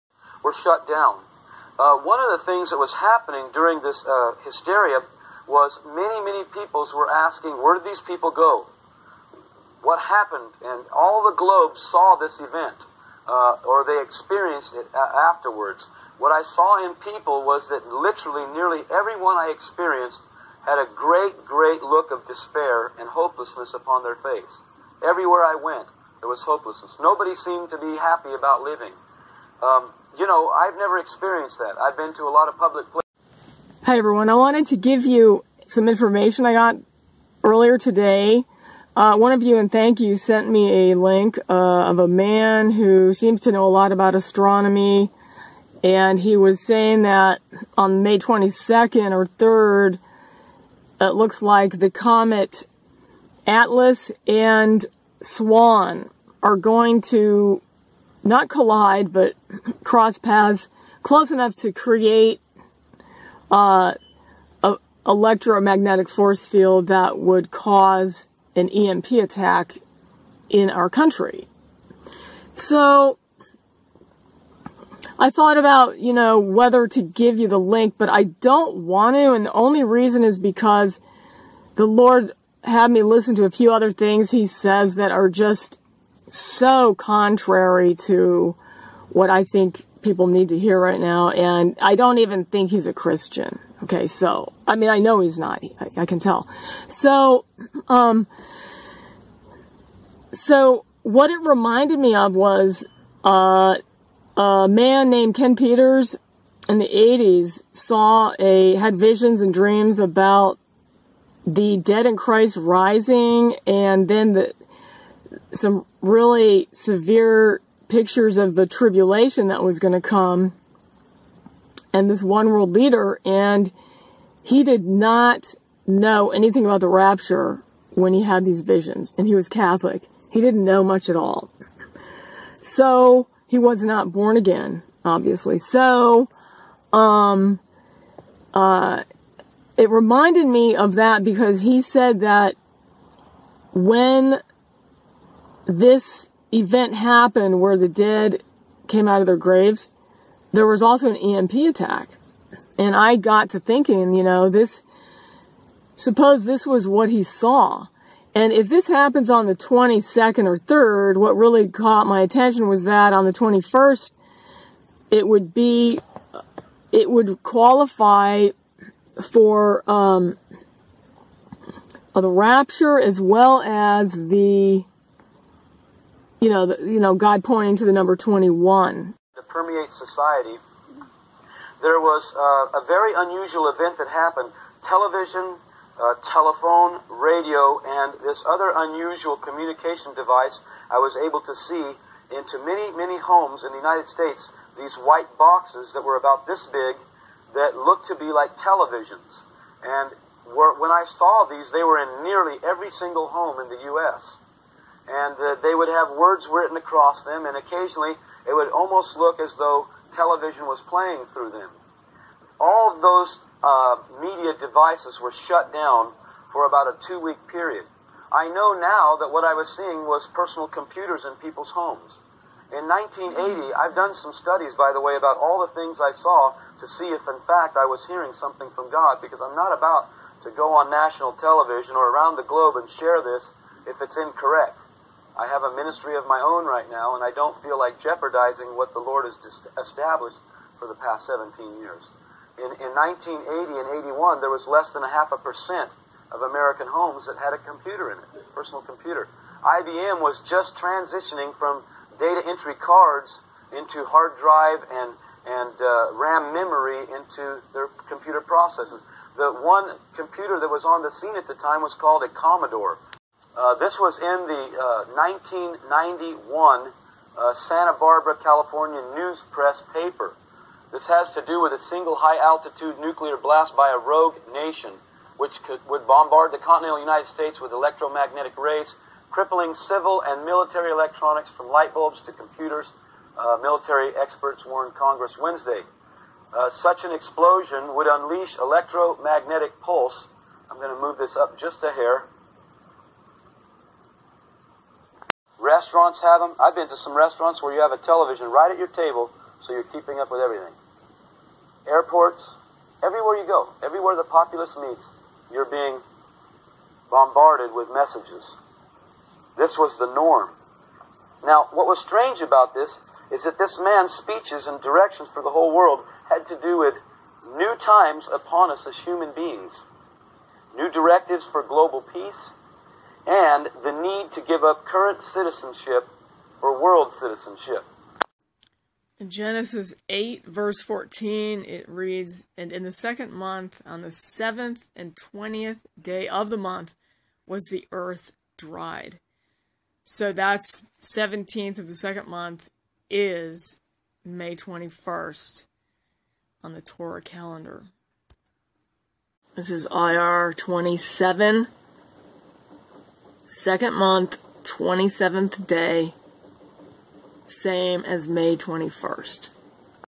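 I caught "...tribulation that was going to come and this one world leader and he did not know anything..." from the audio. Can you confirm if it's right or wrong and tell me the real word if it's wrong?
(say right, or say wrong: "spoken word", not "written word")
right.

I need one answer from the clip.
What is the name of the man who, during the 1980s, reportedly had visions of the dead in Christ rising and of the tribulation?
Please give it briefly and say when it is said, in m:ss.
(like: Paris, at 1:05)
Ken Peters, at 1:45.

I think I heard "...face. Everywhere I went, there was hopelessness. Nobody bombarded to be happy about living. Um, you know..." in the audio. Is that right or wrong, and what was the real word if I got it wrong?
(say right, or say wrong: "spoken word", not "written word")
wrong: "seemed", not "bombarded".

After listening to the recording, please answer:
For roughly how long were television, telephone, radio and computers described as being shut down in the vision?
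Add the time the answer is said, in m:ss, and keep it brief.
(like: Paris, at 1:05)
2 weeks, at 3:37.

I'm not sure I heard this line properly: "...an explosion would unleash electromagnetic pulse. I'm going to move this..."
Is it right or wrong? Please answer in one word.
right.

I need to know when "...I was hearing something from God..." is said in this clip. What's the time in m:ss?
3:47.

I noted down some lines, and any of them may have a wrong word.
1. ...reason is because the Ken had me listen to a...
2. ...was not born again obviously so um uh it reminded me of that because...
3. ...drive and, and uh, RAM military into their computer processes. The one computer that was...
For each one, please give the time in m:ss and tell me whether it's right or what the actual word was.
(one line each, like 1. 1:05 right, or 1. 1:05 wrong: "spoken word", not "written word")
1. 1:19 wrong: "Lord", not "Ken"
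2. 2:13 right
3. 4:14 wrong: "memory", not "military".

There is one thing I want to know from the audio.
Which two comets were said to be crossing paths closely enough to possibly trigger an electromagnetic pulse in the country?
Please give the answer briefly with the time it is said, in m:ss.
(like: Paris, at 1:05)
Atlas and Swan, at 0:53.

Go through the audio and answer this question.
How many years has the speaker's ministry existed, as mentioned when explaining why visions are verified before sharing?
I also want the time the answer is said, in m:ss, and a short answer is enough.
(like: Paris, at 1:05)
17 years, at 4:01.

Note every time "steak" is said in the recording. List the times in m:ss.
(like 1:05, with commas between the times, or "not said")
not said.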